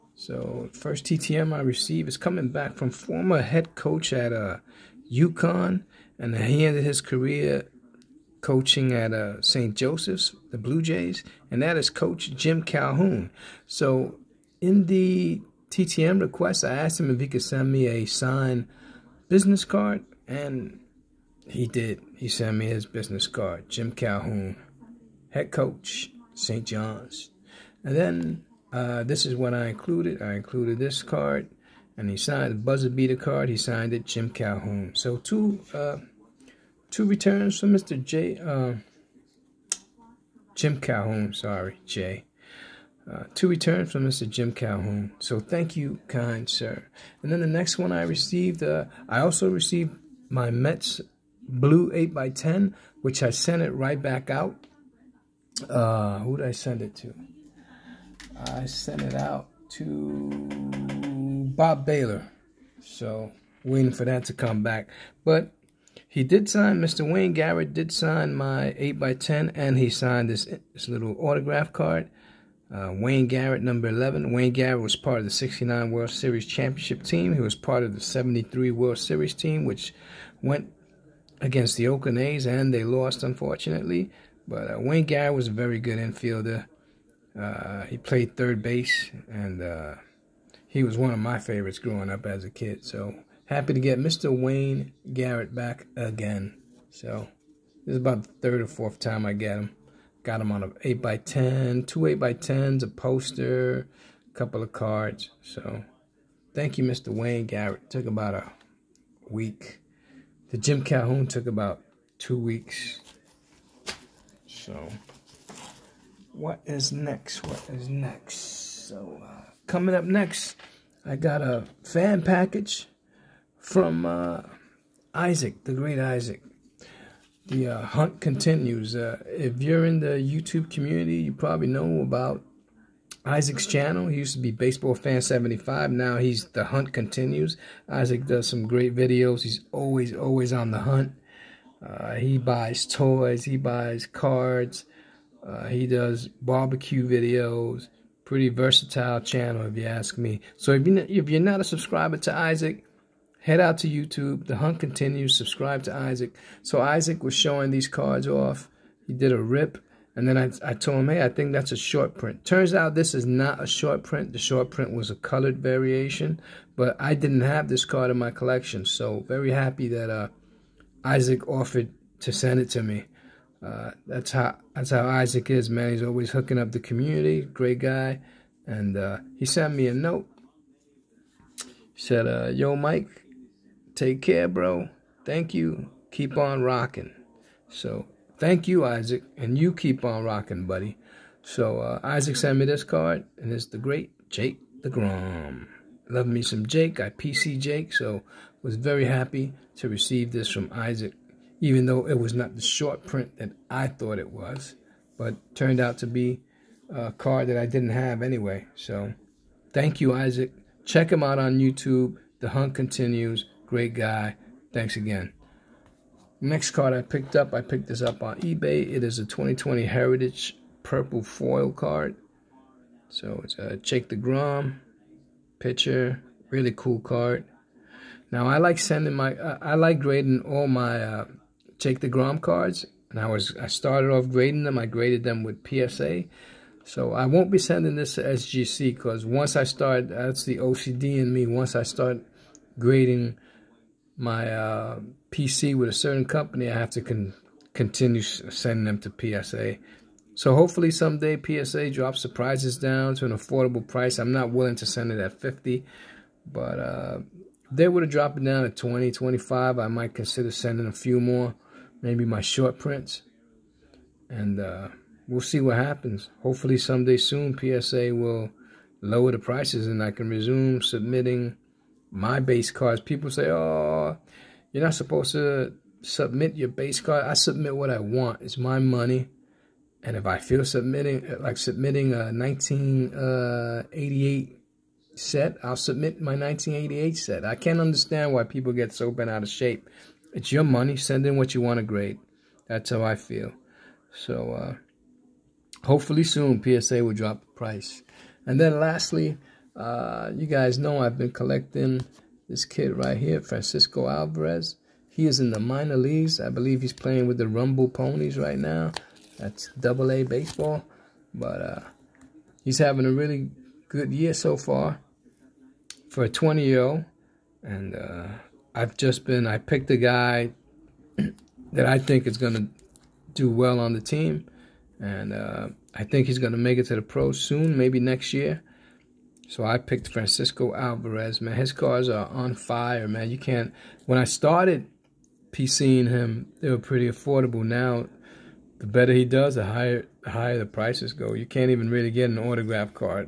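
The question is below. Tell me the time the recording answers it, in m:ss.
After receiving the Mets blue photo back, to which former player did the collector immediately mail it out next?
1:01.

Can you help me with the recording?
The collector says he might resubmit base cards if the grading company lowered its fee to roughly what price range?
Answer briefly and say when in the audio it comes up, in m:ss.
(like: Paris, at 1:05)
20 to 25, at 4:18.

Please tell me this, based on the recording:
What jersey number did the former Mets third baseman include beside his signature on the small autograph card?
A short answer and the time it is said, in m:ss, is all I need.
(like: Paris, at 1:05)
11, at 1:13.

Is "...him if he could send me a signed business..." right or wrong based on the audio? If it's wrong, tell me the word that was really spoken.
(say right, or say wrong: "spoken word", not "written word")
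right.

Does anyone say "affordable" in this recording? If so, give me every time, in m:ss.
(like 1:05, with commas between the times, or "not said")
4:13, 5:37.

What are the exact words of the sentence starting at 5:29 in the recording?
So I picked Francisco Alvarez, man.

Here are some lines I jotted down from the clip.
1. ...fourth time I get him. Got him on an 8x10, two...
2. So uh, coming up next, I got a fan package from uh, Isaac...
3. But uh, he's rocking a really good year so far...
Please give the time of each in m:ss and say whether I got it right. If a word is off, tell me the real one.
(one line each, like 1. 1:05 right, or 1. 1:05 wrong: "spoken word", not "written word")
1. 1:38 right
2. 1:58 right
3. 5:11 wrong: "having", not "rocking".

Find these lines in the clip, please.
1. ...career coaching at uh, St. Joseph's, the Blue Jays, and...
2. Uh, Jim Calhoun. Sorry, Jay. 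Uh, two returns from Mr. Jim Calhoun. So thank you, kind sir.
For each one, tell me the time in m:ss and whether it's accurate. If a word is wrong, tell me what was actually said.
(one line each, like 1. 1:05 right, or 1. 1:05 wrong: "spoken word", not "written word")
1. 0:07 right
2. 0:38 right.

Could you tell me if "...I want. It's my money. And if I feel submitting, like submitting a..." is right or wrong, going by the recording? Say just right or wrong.
right.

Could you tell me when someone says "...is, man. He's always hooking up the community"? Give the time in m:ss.
2:55.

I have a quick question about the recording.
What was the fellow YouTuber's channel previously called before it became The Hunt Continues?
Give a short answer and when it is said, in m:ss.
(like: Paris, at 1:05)
Baseball Fan 75, at 2:14.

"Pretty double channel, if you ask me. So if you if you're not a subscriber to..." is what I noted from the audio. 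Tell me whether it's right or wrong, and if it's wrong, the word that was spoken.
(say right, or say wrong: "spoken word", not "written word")
wrong: "versatile", not "double".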